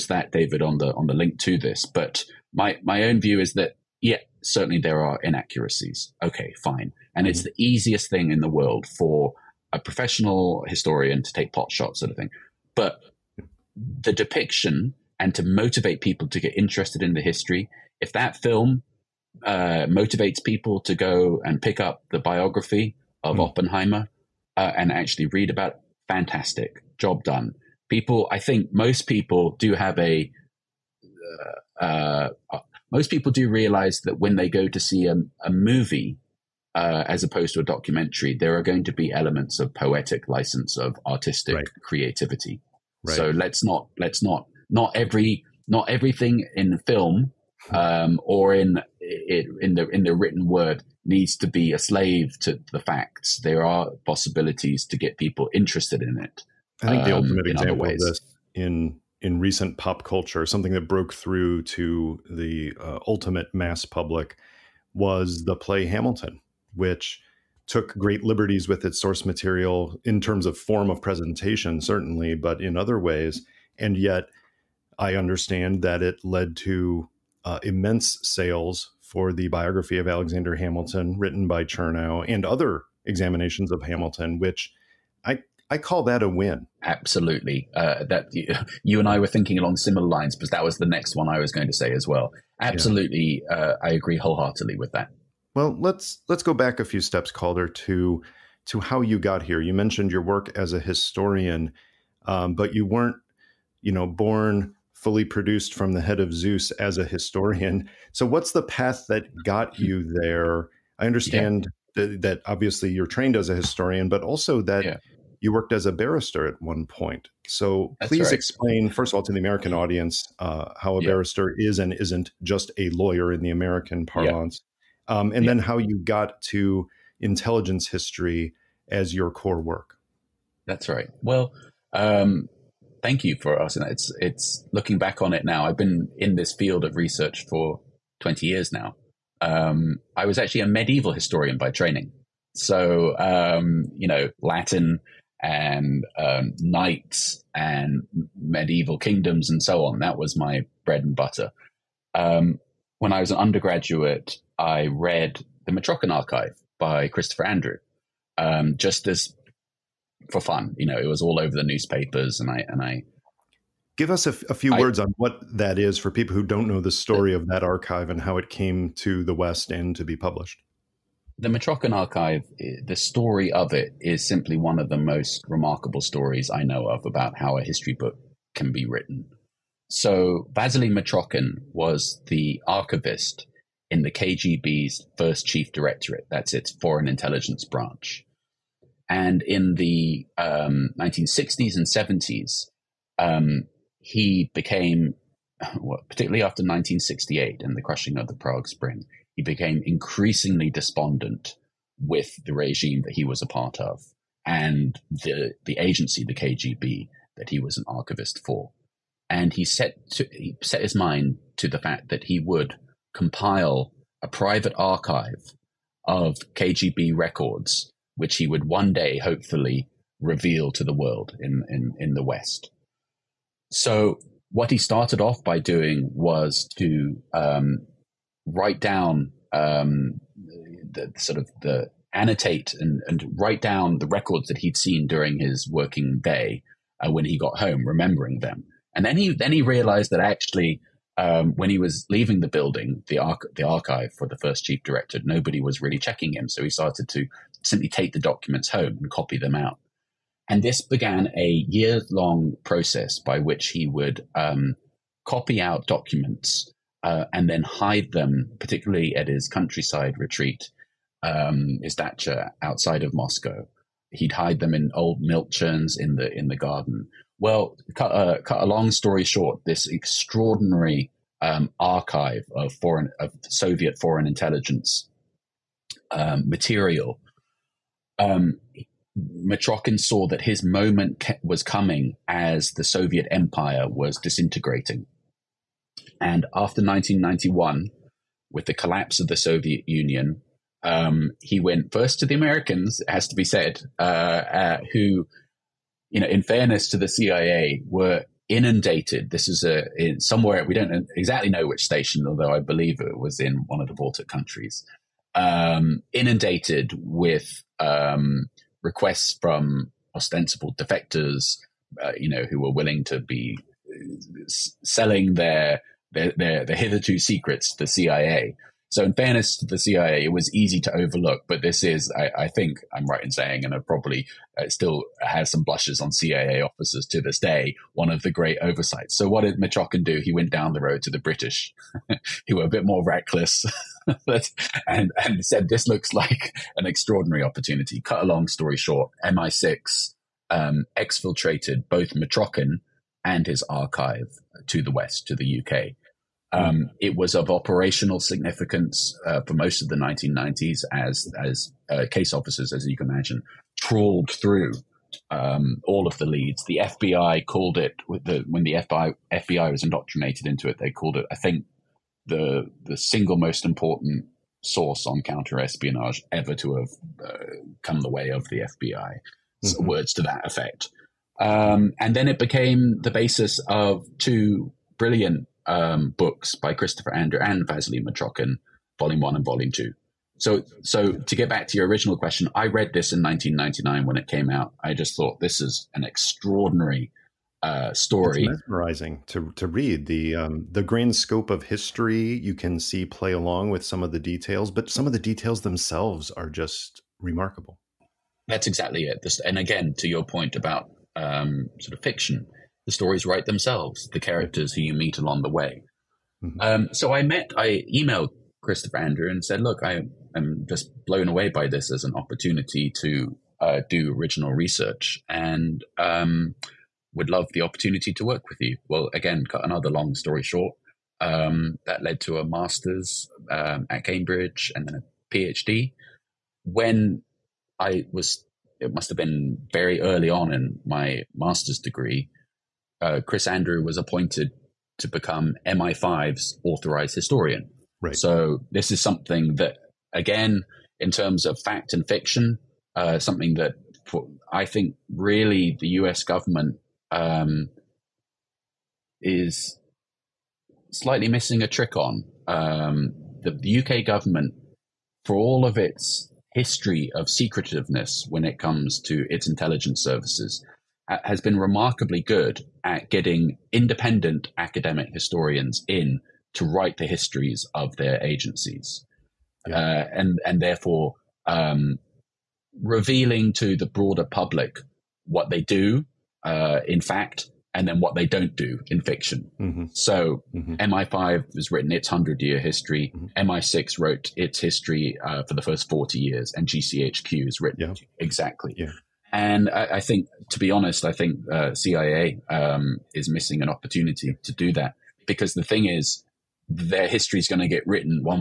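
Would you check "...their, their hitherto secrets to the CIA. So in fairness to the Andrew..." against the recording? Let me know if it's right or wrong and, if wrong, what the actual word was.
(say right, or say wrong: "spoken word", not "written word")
wrong: "CIA", not "Andrew".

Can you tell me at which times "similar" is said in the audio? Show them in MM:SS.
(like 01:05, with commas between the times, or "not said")
01:29.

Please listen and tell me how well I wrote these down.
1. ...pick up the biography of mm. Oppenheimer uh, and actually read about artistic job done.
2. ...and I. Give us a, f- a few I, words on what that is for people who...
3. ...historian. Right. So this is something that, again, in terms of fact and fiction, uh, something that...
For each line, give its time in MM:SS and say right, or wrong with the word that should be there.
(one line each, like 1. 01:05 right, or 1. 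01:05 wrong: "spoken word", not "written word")
1. 00:21 wrong: "fantastic", not "artistic"
2. 02:42 right
3. 07:17 right.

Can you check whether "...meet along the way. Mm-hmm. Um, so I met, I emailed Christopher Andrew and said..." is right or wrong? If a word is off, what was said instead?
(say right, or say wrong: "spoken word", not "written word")
right.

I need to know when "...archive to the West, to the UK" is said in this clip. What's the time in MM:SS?
05:43.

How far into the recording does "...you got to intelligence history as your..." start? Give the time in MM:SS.
02:05.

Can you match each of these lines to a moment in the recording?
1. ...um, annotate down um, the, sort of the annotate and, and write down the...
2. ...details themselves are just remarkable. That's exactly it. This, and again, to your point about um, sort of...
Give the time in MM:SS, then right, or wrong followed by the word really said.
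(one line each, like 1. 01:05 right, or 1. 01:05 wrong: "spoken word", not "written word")
1. 03:47 wrong: "write", not "annotate"
2. 06:35 right.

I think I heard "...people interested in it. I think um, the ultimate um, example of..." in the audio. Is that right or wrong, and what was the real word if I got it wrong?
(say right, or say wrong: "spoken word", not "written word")
right.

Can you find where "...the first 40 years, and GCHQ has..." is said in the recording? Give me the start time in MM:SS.
08:05.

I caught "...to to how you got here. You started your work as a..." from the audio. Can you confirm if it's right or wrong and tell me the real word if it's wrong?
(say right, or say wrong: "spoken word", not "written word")
wrong: "mentioned", not "started".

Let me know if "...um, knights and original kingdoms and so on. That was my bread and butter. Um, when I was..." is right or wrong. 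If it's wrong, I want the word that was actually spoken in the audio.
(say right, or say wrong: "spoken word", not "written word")
wrong: "medieval", not "original".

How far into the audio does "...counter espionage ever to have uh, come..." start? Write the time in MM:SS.
06:05.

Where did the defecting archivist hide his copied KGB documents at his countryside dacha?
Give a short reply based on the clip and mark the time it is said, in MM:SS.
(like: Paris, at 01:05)
Old milk churns, at 04:24.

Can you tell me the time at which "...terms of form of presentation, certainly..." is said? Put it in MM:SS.
01:10.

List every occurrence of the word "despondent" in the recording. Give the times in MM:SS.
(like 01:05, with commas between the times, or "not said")
03:20.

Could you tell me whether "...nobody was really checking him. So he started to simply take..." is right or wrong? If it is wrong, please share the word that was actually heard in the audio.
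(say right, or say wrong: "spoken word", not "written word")
right.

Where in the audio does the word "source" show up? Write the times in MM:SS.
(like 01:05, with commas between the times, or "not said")
01:08, 06:04.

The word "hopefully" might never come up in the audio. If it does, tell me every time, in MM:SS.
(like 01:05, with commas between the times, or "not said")
03:39.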